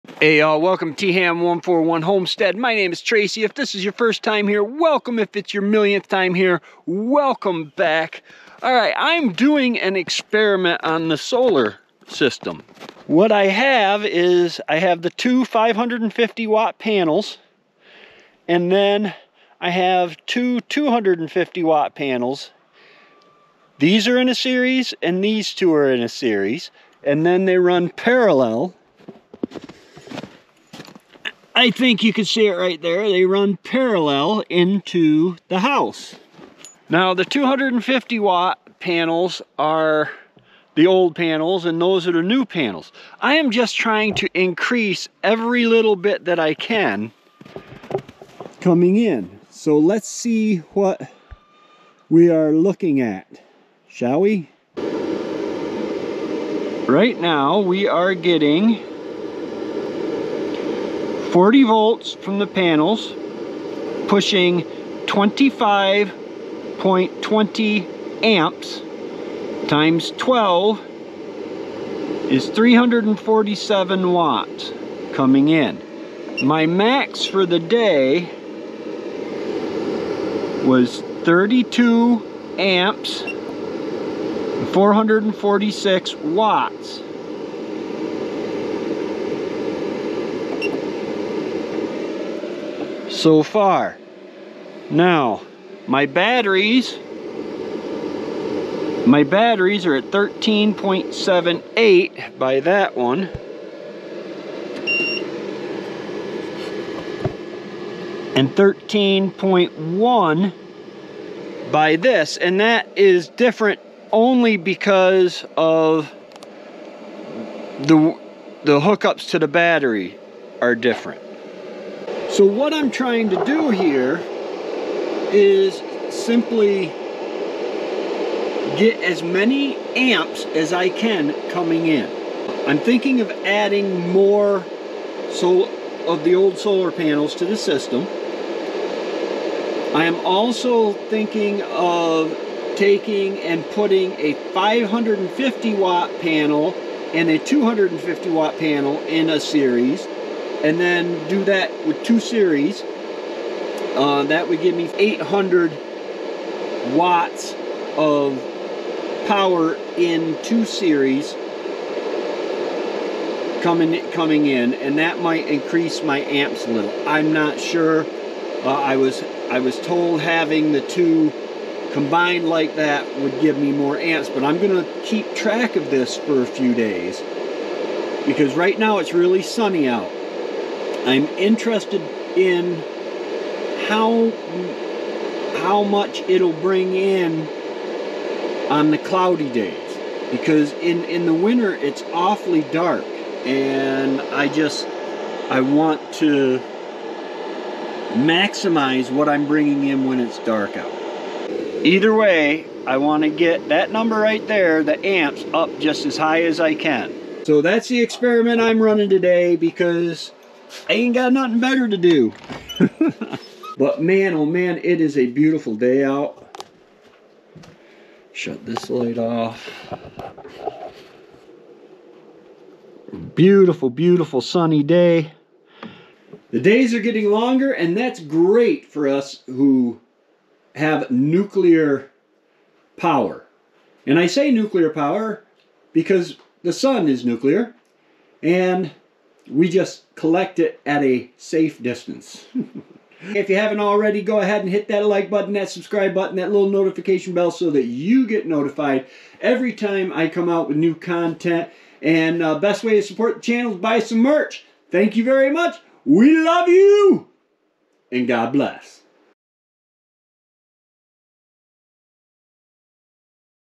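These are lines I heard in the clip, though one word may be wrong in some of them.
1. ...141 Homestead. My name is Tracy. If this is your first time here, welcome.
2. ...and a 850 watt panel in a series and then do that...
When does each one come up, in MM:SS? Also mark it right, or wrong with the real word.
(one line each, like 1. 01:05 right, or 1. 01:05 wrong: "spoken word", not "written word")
1. 00:01 right
2. 02:27 wrong: "250", not "850".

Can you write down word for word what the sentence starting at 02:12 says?
I'm thinking of adding more so of the old solar panels to the system.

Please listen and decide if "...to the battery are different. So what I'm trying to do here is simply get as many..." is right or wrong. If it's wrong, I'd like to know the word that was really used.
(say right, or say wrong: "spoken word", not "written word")
right.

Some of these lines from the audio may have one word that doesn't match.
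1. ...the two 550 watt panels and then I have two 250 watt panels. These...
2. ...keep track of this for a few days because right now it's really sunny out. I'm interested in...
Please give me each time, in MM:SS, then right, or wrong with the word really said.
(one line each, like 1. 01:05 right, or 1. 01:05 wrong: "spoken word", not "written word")
1. 00:15 right
2. 02:55 right.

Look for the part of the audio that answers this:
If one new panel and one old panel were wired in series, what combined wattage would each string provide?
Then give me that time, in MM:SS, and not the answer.
02:34.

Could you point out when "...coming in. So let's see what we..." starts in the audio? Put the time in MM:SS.
00:48.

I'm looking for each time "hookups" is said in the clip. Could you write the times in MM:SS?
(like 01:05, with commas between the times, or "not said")
01:58.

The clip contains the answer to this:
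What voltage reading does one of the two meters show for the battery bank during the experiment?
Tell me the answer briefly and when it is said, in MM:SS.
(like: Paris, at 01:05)
13.78, at 01:40.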